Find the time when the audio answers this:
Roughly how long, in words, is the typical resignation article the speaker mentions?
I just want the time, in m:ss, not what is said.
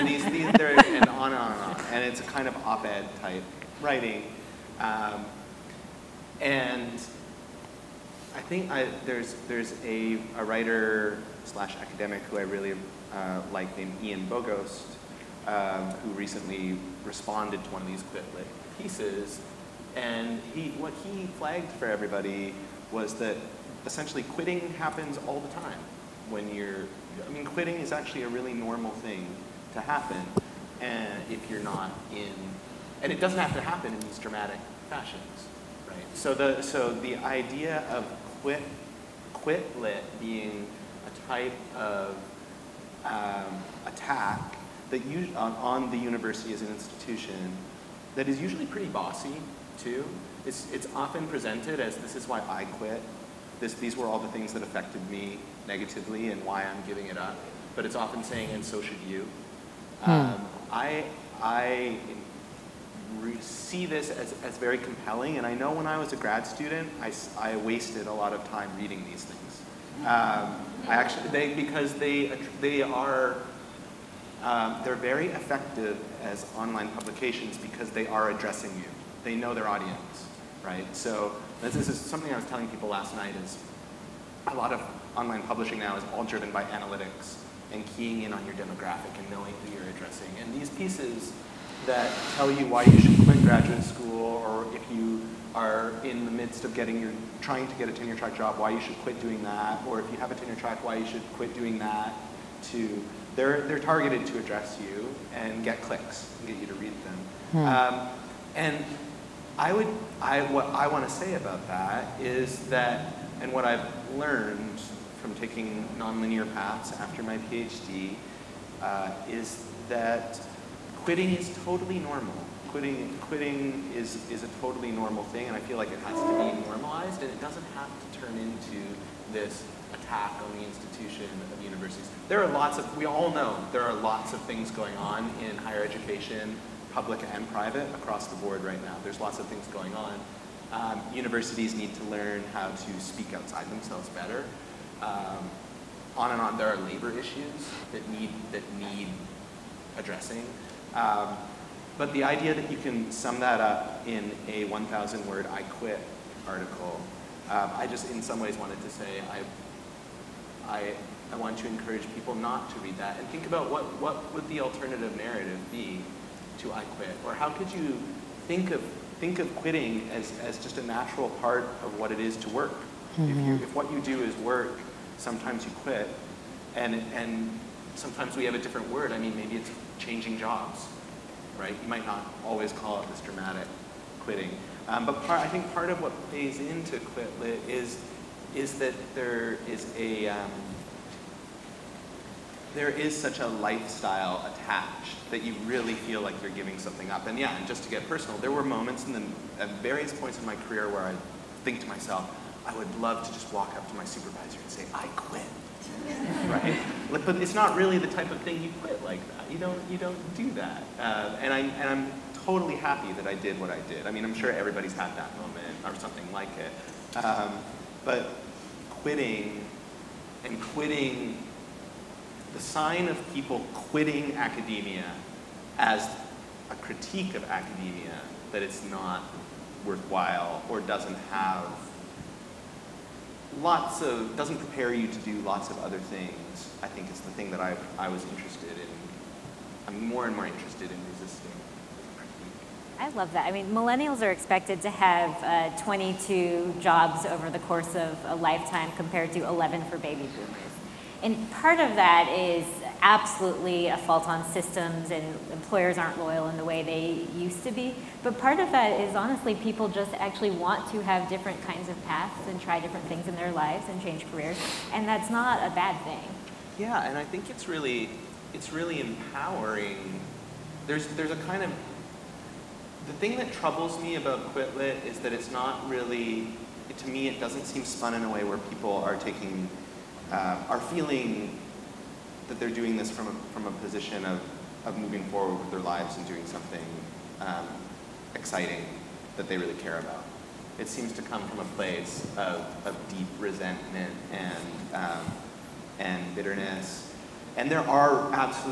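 2:34.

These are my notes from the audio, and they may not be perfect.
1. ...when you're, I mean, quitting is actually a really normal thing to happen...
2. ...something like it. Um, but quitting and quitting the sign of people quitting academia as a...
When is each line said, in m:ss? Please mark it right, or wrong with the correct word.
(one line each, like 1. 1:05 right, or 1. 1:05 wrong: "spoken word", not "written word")
1. 0:26 right
2. 3:35 right.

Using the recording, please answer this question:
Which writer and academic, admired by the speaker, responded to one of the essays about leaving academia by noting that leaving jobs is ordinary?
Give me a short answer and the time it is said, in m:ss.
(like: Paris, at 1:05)
Ian Bogost, at 0:14.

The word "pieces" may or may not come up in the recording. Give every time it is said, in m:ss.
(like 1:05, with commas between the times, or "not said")
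0:18, 1:30.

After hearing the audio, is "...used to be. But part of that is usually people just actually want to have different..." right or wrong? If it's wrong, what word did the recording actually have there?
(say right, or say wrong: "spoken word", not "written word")
wrong: "honestly", not "usually".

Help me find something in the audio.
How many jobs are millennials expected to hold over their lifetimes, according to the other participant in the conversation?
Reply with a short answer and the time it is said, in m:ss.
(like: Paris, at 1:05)
22, at 4:05.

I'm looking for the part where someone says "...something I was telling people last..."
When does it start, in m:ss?
1:21.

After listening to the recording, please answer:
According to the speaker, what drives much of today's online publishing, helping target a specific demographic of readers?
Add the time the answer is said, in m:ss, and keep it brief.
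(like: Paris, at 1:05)
analytics, at 1:26.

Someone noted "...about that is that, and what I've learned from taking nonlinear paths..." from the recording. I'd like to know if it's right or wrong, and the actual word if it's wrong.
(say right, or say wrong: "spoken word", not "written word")
right.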